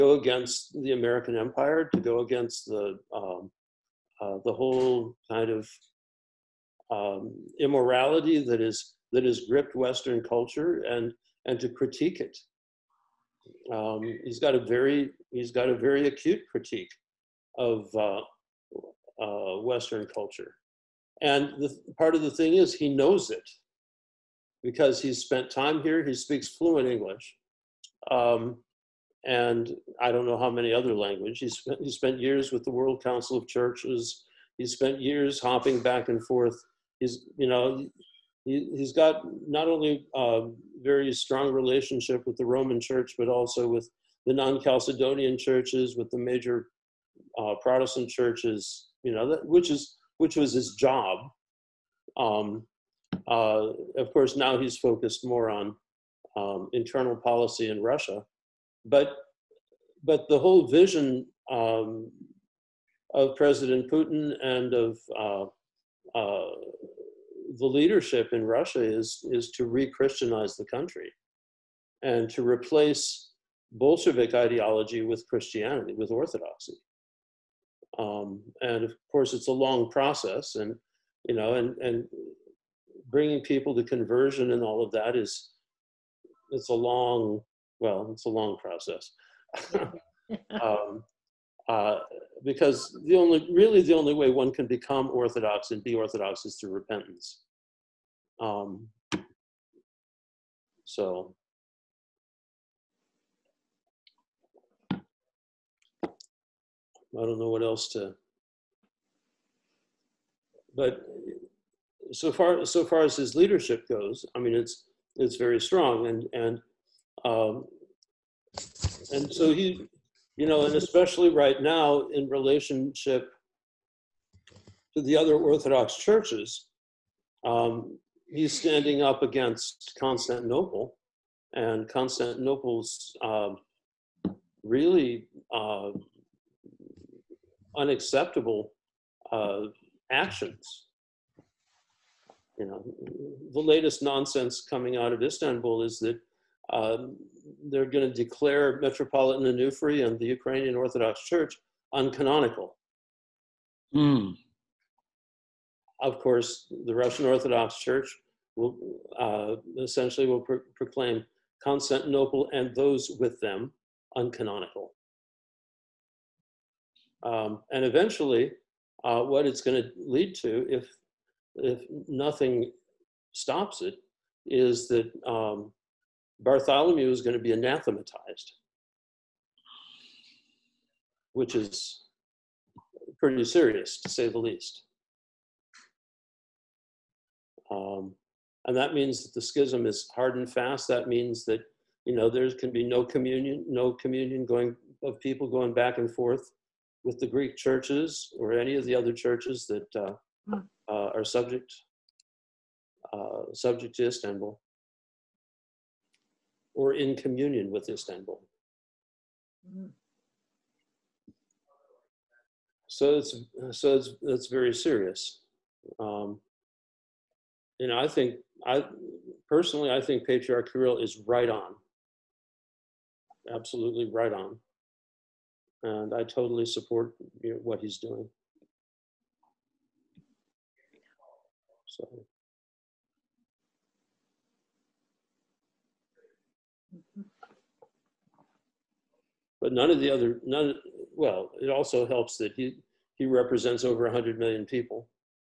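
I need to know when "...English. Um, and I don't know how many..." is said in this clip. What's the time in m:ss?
0:26.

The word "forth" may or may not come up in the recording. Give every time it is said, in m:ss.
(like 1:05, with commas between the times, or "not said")
0:36, 3:16.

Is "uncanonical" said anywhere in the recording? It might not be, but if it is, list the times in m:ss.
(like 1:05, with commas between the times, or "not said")
2:31, 2:44.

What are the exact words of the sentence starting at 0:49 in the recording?
You know, that, which is which was his job.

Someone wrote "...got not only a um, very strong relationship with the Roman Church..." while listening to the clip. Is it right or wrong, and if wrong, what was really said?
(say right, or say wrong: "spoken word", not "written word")
right.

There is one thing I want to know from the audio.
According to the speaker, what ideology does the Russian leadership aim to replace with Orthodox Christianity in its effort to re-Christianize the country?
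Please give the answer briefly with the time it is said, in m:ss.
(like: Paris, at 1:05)
Bolshevik ideology, at 1:13.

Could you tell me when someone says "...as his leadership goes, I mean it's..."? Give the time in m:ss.
1:53.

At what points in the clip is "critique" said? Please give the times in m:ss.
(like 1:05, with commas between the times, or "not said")
0:11, 0:16.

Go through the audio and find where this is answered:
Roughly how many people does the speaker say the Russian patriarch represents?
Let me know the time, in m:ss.
4:03.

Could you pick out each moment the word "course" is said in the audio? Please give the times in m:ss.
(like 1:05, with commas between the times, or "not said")
0:54, 1:19, 2:36.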